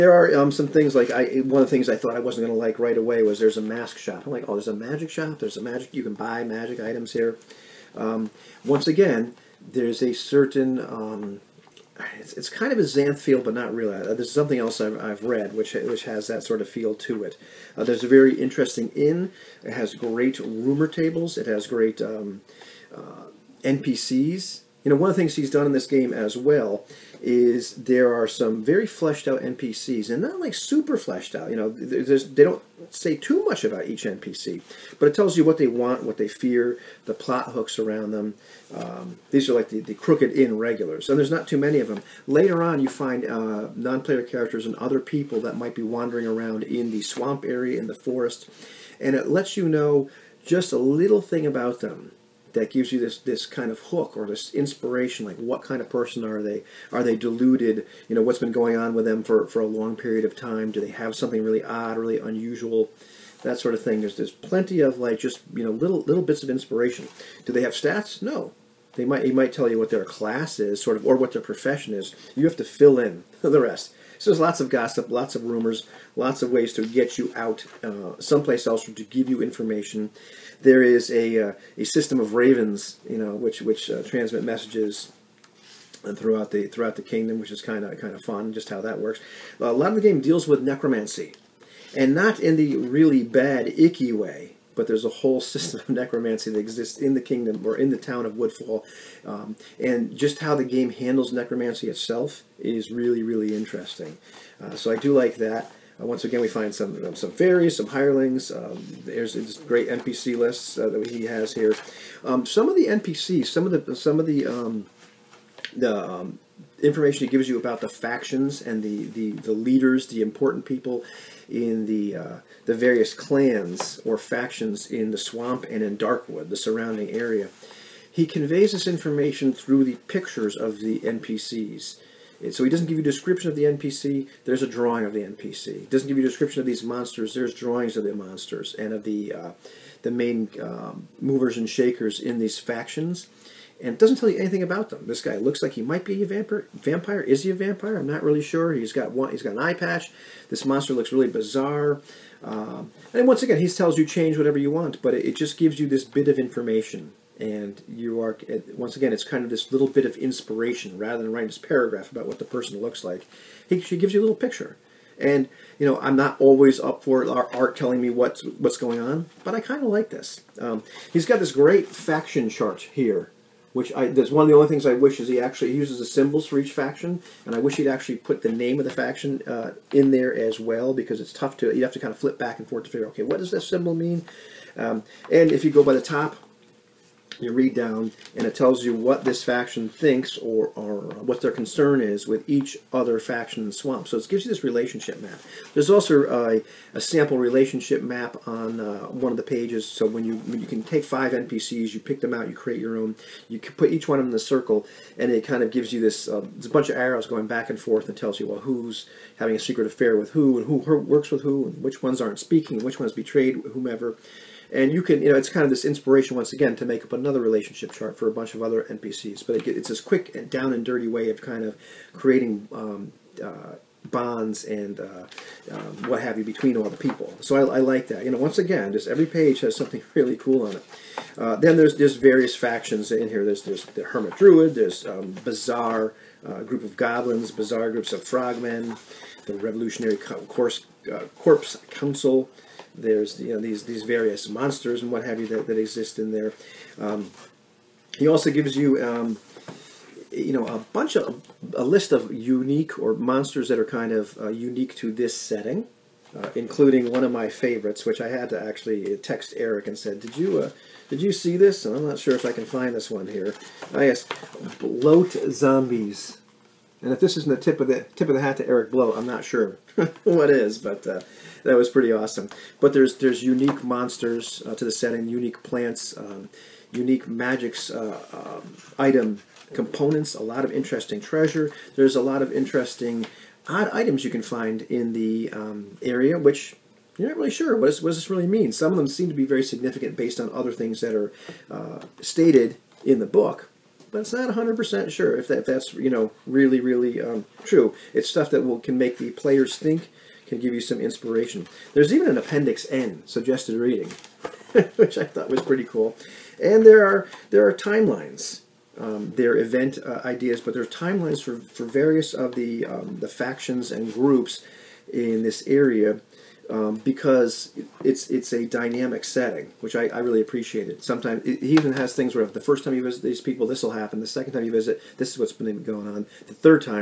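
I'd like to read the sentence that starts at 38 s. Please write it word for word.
Um, these are like the, the crooked inn regulars, and there's not too many of them.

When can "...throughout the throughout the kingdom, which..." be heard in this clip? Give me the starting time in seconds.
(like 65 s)
86 s.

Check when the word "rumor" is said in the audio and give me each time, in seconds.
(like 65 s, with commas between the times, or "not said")
20 s, 75 s.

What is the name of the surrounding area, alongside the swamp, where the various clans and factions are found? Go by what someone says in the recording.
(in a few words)
Darkwood.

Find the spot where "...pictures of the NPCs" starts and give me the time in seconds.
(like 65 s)
130 s.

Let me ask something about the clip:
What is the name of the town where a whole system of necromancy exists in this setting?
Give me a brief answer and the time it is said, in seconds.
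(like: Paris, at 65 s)
Woodfall, at 98 s.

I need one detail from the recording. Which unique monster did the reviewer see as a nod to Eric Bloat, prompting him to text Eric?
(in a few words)
Bloat zombies.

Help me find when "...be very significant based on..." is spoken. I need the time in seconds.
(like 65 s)
289 s.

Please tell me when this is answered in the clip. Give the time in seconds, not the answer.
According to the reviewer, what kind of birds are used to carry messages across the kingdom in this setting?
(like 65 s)
82 s.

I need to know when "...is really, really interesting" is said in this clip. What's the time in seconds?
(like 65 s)
102 s.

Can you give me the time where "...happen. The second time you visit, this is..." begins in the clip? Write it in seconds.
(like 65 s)
323 s.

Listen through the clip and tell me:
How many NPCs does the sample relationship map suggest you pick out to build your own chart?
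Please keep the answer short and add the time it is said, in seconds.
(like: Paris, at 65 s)
5, at 201 s.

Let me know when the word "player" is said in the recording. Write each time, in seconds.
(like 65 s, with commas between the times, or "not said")
44 s, 299 s.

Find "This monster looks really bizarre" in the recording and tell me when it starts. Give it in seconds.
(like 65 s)
150 s.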